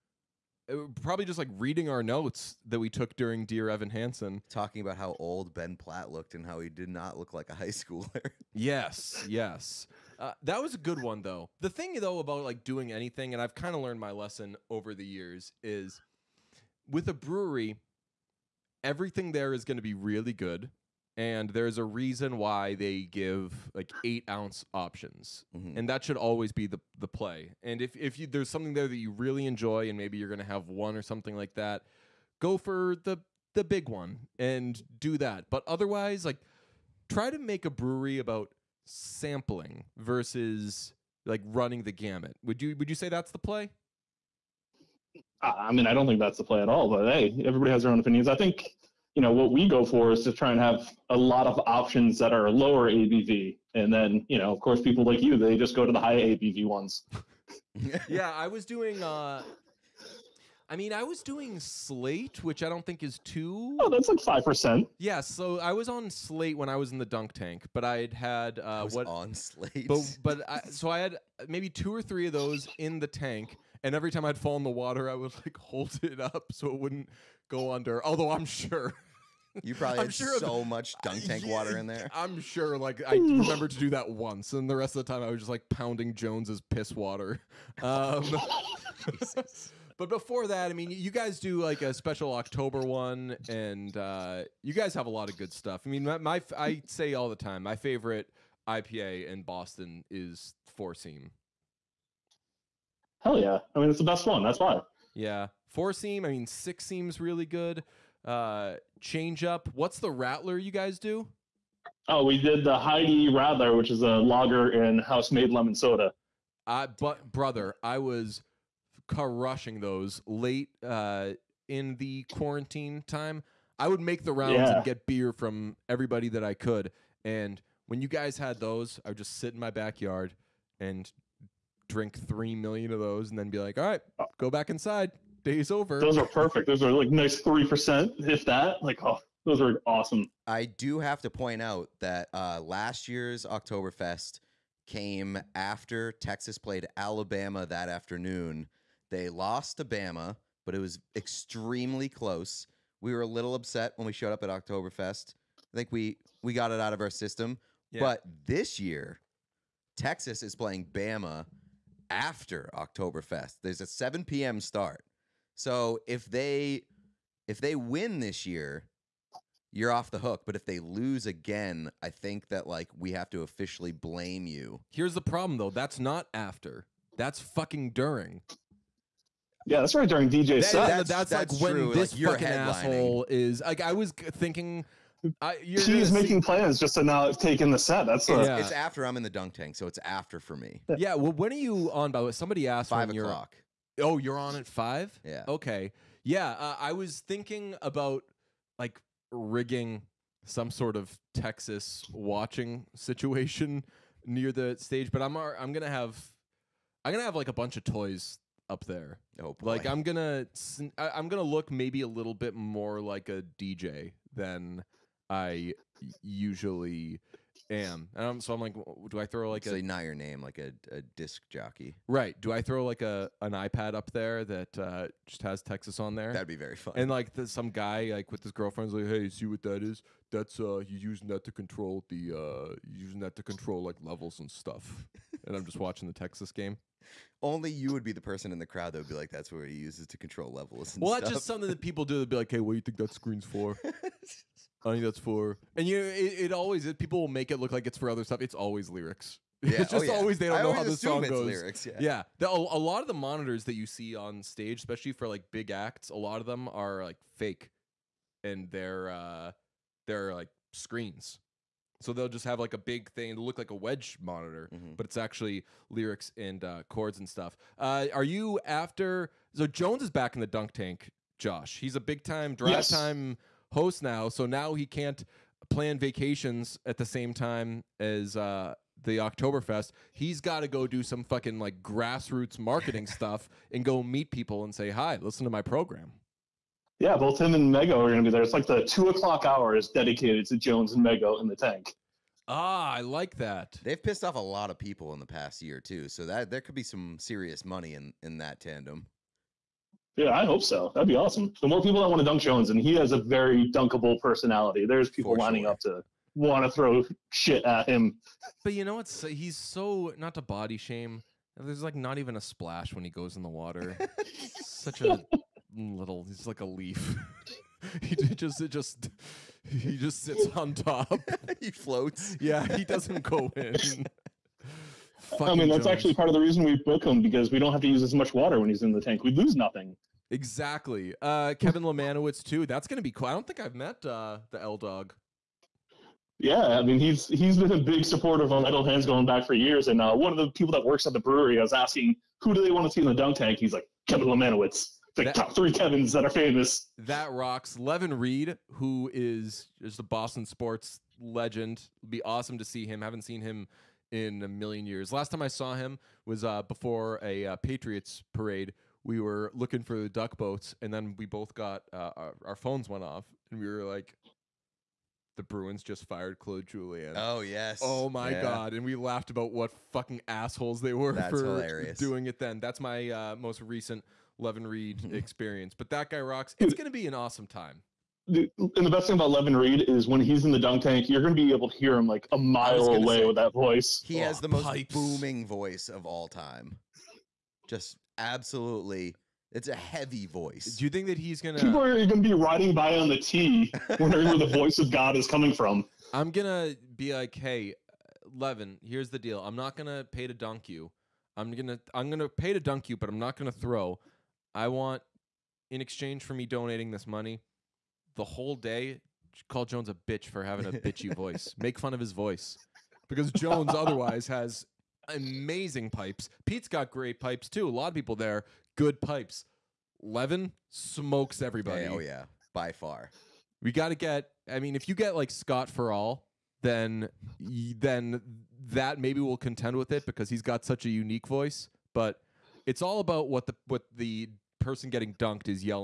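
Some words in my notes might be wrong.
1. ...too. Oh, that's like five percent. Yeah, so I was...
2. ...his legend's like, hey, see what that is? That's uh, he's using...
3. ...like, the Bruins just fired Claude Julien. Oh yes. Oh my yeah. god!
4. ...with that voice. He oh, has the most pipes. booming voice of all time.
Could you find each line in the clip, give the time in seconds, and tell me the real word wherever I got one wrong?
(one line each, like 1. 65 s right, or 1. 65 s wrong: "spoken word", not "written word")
1. 63 s right
2. 228 s wrong: "girlfriend", not "legend"
3. 363 s right
4. 383 s right.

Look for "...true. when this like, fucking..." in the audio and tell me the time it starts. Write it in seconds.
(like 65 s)
181 s.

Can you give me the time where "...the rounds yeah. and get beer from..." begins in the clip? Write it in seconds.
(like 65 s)
124 s.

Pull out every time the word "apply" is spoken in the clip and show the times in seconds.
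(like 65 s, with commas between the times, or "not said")
not said.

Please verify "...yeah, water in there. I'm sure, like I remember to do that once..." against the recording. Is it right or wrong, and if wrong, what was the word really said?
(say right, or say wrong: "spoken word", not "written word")
right.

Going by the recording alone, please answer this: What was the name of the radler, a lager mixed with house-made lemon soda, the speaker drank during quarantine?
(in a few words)
Heidi Radler.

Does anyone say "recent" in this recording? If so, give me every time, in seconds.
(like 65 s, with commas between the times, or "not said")
373 s.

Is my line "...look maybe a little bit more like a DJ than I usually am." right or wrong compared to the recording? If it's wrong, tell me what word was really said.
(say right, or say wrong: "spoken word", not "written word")
right.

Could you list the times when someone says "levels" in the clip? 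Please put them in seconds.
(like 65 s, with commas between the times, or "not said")
234 s, 240 s.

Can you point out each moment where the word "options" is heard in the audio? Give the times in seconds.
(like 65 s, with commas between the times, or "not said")
24 s, 51 s.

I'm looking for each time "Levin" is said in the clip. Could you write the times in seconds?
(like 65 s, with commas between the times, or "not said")
347 s, 374 s, 379 s, 398 s, 420 s.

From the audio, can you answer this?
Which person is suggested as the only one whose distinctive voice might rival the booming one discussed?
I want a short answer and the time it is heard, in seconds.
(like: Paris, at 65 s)
Scott Zolak, at 425 s.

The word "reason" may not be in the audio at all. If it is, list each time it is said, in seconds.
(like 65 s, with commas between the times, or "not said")
21 s, 326 s.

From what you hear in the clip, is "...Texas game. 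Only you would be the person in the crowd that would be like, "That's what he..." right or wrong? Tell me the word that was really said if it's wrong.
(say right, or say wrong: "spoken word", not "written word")
right.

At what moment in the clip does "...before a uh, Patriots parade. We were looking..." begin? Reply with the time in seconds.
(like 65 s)
356 s.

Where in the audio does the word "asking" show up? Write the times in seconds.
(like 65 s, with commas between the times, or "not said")
341 s.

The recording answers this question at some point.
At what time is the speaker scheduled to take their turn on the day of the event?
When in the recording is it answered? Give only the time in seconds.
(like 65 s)
192 s.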